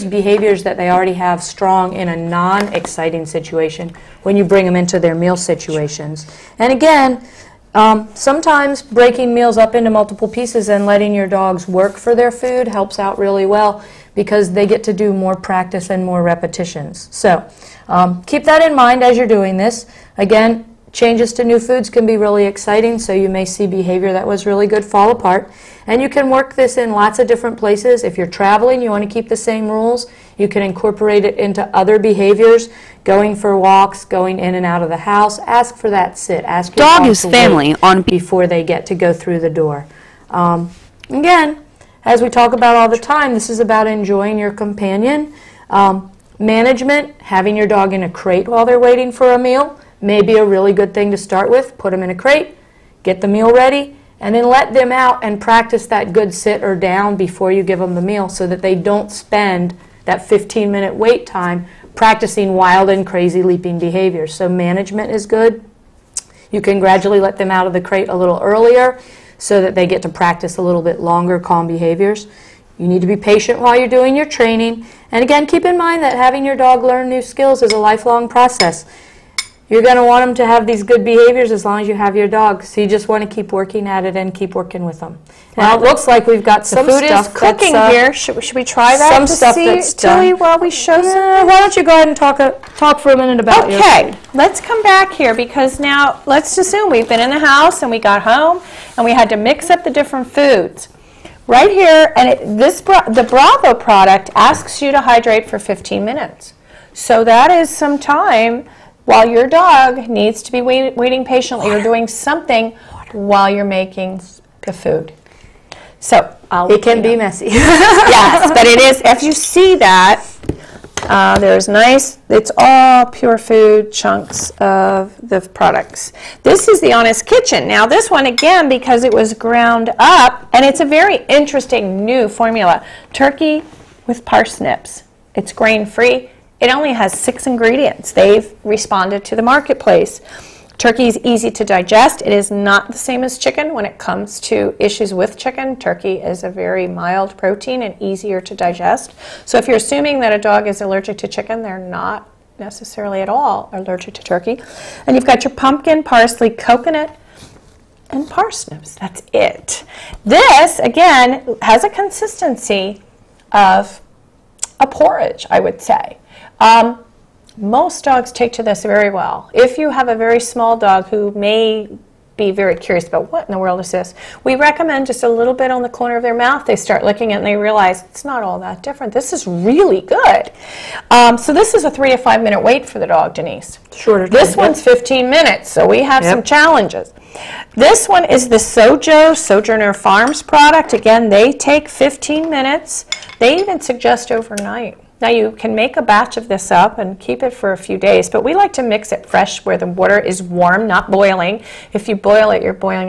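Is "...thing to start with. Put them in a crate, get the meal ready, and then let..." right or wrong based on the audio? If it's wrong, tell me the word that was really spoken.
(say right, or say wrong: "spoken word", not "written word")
right.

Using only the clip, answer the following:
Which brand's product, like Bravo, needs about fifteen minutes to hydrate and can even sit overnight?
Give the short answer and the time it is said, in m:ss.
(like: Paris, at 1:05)
Sojourner Farms, at 3:09.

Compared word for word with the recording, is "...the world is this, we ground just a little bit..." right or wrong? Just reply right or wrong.
wrong.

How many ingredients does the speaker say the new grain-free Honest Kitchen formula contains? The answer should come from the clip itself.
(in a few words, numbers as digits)
6.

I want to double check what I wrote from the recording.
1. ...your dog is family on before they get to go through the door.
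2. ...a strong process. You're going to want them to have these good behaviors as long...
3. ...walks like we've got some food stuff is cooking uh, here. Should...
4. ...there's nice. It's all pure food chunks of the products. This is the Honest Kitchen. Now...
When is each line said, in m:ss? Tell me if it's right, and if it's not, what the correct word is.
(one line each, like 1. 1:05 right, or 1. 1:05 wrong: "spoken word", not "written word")
1. 0:36 right
2. 1:17 wrong: "lifelong", not "strong"
3. 1:25 wrong: "looks", not "walks"
4. 2:01 right.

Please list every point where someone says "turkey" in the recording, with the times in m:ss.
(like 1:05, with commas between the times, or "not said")
2:13, 2:20, 2:25, 2:34.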